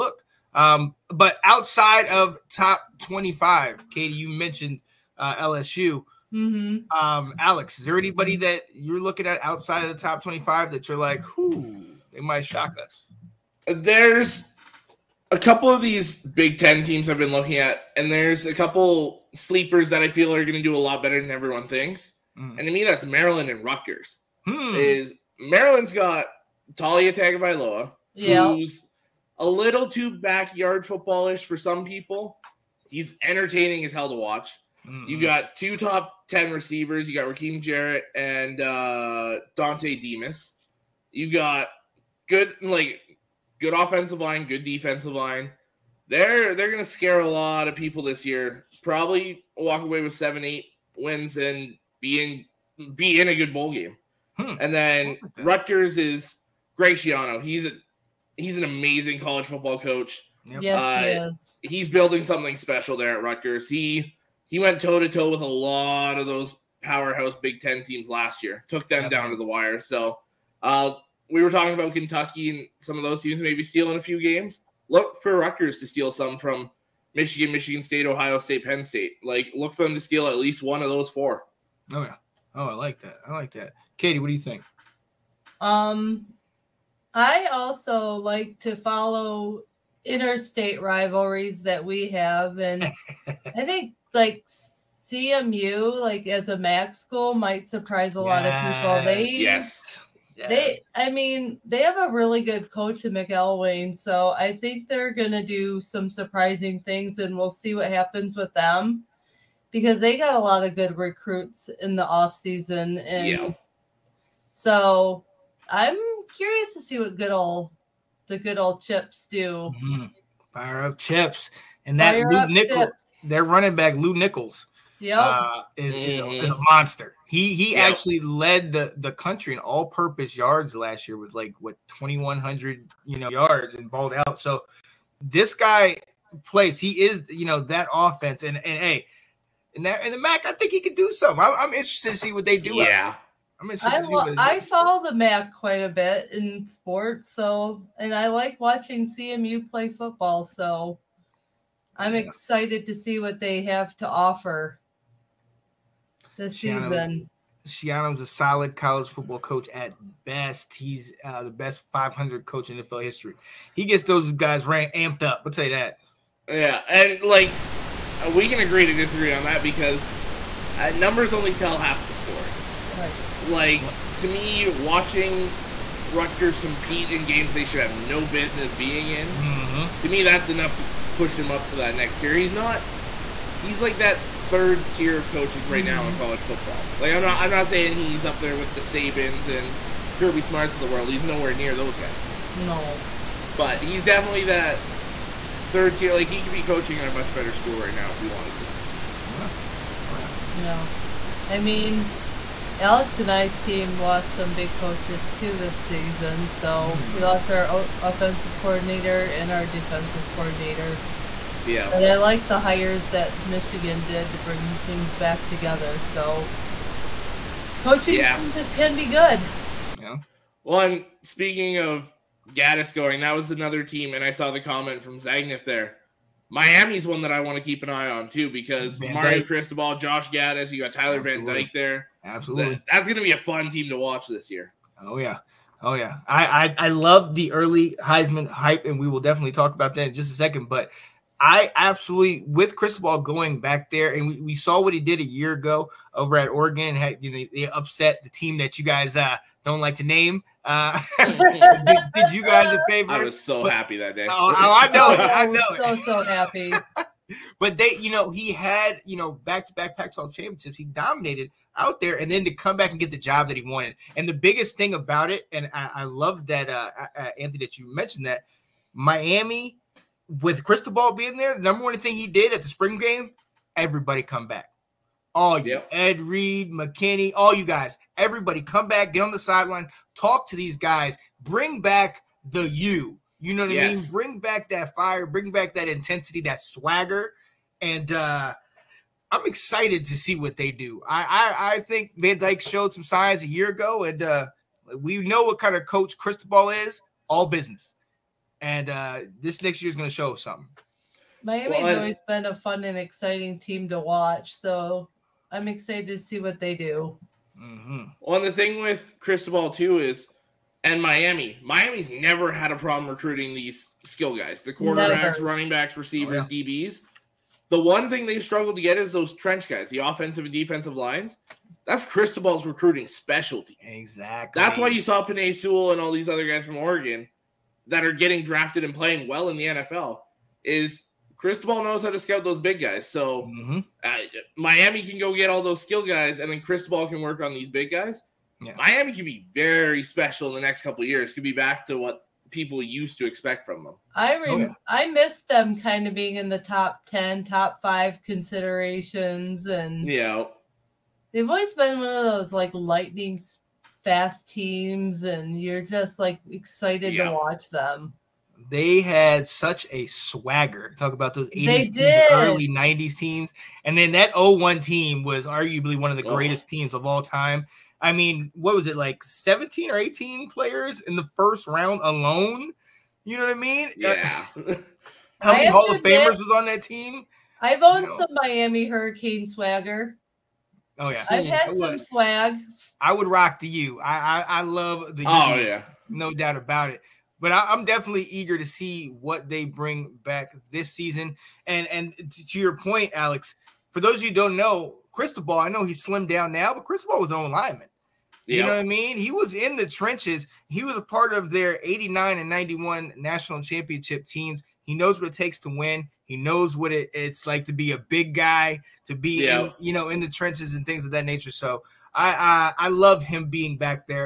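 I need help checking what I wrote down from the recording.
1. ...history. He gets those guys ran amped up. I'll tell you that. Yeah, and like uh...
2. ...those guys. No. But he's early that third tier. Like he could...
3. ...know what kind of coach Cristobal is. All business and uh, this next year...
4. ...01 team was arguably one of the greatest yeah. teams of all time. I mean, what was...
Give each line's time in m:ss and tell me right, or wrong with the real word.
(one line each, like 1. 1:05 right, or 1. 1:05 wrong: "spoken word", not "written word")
1. 2:43 right
2. 3:11 wrong: "definitely", not "early"
3. 4:55 right
4. 6:04 right.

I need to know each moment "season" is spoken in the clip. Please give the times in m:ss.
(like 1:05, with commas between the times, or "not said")
1:52, 2:36, 3:25, 6:30.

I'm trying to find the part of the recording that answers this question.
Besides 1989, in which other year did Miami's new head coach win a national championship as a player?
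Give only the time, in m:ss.
6:42.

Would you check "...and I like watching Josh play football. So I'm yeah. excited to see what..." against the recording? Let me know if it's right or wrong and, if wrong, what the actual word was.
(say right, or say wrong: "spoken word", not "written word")
wrong: "CMU", not "Josh".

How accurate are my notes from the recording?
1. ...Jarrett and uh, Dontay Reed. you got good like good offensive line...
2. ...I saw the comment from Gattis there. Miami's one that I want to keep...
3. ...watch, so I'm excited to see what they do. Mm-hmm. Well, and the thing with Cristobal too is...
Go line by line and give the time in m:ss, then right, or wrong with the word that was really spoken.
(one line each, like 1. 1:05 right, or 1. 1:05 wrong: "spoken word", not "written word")
1. 0:37 wrong: "Demus", not "Reed"
2. 3:44 wrong: "Zagnif", not "Gattis"
3. 5:03 right.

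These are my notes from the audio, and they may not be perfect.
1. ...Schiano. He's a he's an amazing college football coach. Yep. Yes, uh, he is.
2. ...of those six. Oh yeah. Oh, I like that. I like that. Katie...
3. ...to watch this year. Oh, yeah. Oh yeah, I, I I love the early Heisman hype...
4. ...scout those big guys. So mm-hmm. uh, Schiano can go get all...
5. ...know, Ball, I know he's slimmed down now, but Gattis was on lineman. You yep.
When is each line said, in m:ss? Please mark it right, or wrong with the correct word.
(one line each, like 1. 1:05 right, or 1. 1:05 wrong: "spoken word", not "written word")
1. 0:56 right
2. 1:20 wrong: "four", not "six"
3. 3:53 right
4. 5:32 wrong: "Miami", not "Schiano"
5. 6:34 wrong: "Ball", not "Gattis".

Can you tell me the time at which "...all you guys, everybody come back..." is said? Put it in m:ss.
4:37.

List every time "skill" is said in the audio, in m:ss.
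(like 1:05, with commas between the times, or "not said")
5:14, 5:35.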